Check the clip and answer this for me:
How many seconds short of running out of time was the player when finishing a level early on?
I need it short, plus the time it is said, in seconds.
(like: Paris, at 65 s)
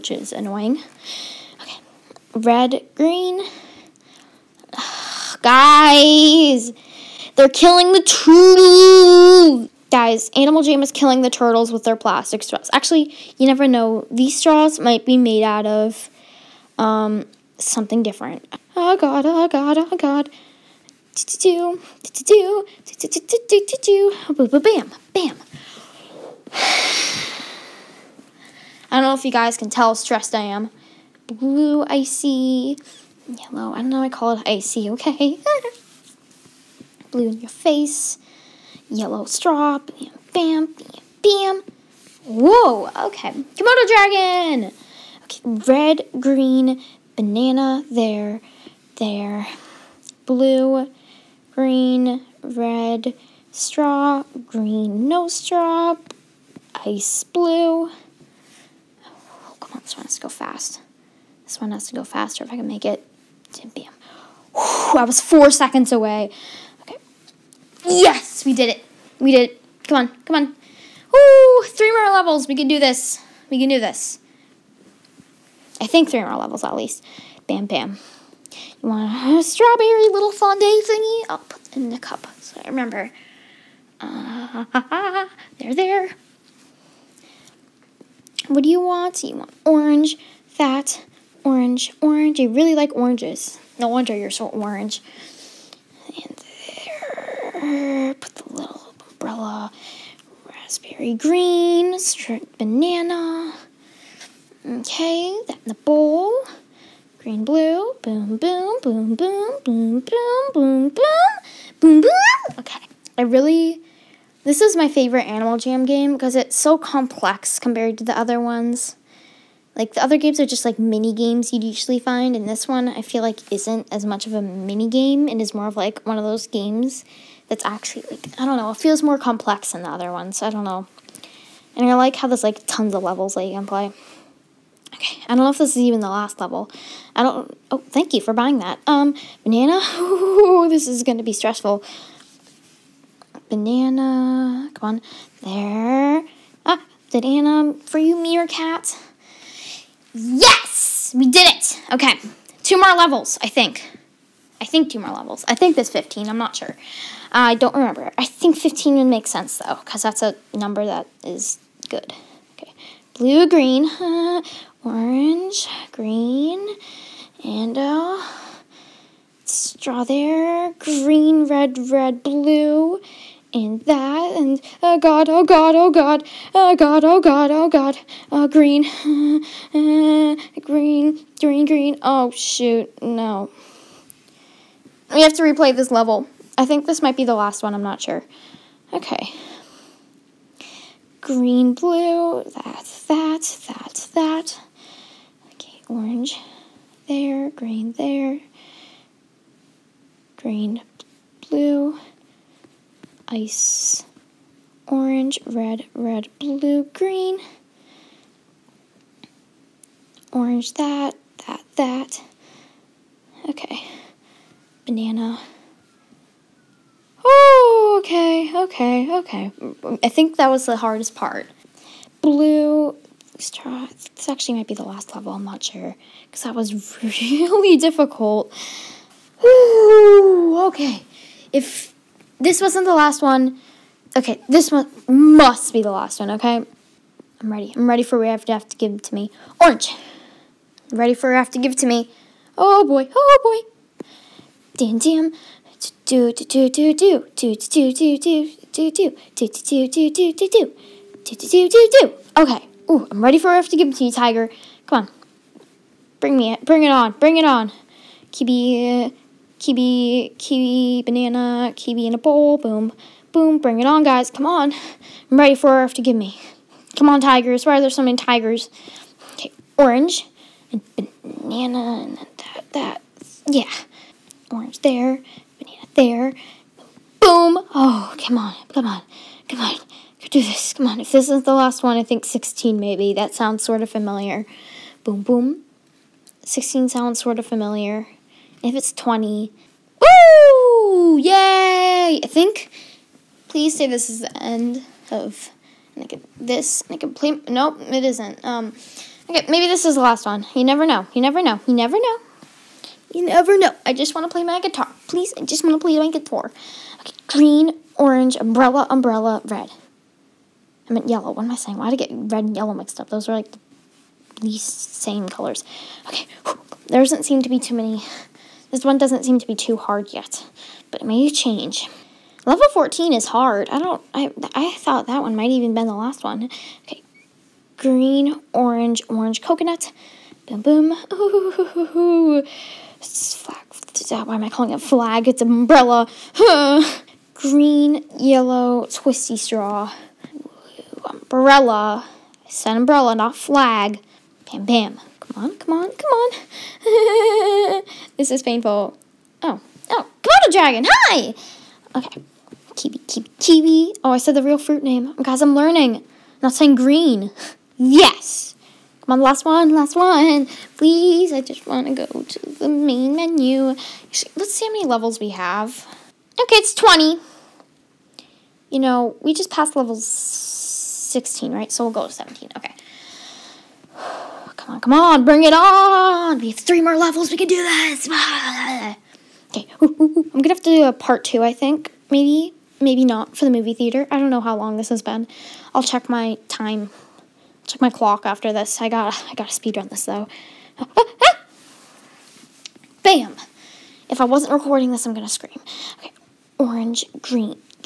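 4, at 65 s.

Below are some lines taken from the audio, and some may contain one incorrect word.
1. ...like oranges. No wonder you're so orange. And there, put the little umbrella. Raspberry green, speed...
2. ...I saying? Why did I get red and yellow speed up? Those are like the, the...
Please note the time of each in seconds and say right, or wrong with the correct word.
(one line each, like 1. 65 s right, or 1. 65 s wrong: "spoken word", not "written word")
1. 92 s wrong: "striped", not "speed"
2. 311 s wrong: "mixed", not "speed".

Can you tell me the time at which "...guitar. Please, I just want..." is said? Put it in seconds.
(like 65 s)
304 s.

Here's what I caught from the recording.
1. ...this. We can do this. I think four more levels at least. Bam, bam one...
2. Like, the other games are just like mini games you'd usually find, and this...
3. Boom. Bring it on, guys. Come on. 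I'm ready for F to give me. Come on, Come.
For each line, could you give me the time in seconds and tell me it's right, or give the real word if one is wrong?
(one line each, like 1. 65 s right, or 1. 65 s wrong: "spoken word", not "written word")
1. 72 s wrong: "three", not "four"
2. 119 s right
3. 263 s wrong: "Tigers", not "Come".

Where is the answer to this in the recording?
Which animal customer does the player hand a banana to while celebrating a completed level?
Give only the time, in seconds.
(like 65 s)
147 s.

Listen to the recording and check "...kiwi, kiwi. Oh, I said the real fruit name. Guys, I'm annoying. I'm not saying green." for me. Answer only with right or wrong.
wrong.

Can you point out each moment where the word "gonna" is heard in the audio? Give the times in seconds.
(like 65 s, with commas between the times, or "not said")
380 s, 395 s.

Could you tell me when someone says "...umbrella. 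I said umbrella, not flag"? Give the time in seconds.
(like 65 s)
341 s.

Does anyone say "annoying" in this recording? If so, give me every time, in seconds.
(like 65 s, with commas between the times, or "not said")
0 s.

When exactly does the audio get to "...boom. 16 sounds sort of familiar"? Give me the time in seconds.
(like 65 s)
285 s.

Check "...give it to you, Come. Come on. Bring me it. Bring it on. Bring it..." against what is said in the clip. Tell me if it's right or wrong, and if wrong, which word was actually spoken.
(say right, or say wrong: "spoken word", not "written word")
wrong: "Tiger", not "Come".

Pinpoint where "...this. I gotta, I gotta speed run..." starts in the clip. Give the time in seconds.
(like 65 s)
388 s.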